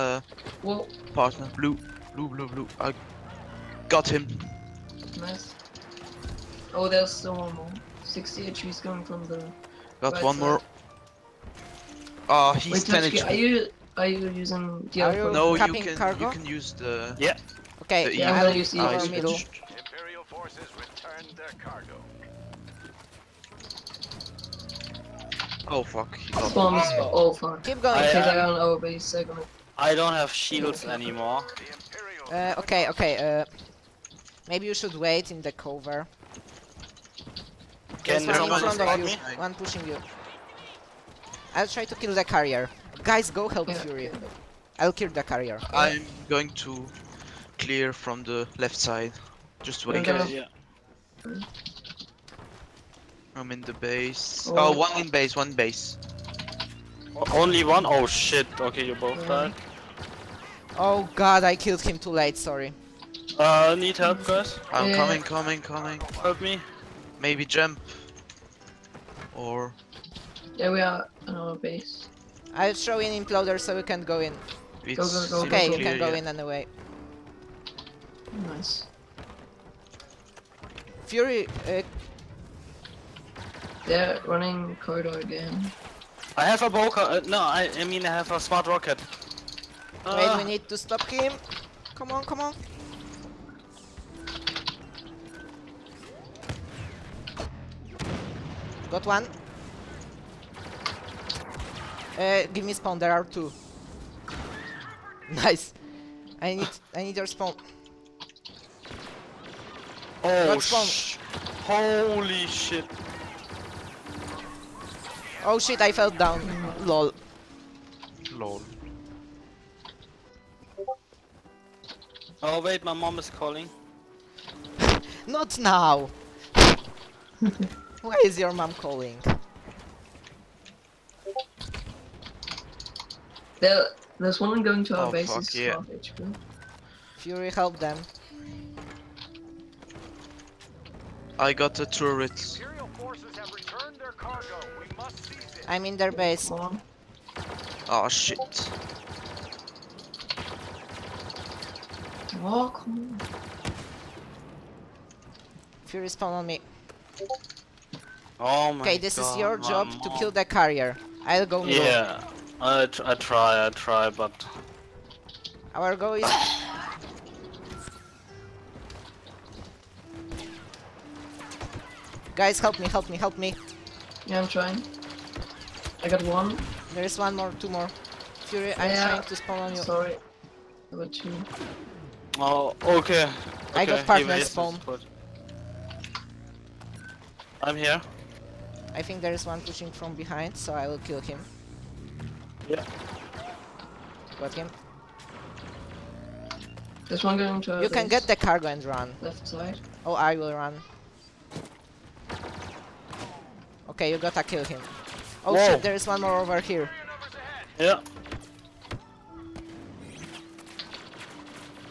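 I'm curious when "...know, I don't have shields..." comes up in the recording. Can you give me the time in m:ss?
0:29.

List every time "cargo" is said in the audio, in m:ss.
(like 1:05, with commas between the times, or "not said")
0:21, 3:18.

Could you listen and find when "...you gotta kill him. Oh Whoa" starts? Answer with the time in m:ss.
3:24.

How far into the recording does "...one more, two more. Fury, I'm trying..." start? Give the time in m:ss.
2:57.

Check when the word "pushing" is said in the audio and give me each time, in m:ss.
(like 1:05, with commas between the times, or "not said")
0:39, 3:09.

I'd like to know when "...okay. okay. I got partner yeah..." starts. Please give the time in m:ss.
3:02.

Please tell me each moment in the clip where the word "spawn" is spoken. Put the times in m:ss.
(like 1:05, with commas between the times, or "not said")
1:42, 1:47, 2:59, 3:04.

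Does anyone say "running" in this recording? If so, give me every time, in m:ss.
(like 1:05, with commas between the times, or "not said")
1:24.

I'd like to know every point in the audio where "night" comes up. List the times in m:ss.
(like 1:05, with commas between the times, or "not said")
not said.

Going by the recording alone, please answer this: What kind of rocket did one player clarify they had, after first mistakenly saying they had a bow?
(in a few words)
Smart rocket.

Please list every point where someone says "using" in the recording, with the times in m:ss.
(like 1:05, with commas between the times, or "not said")
0:14.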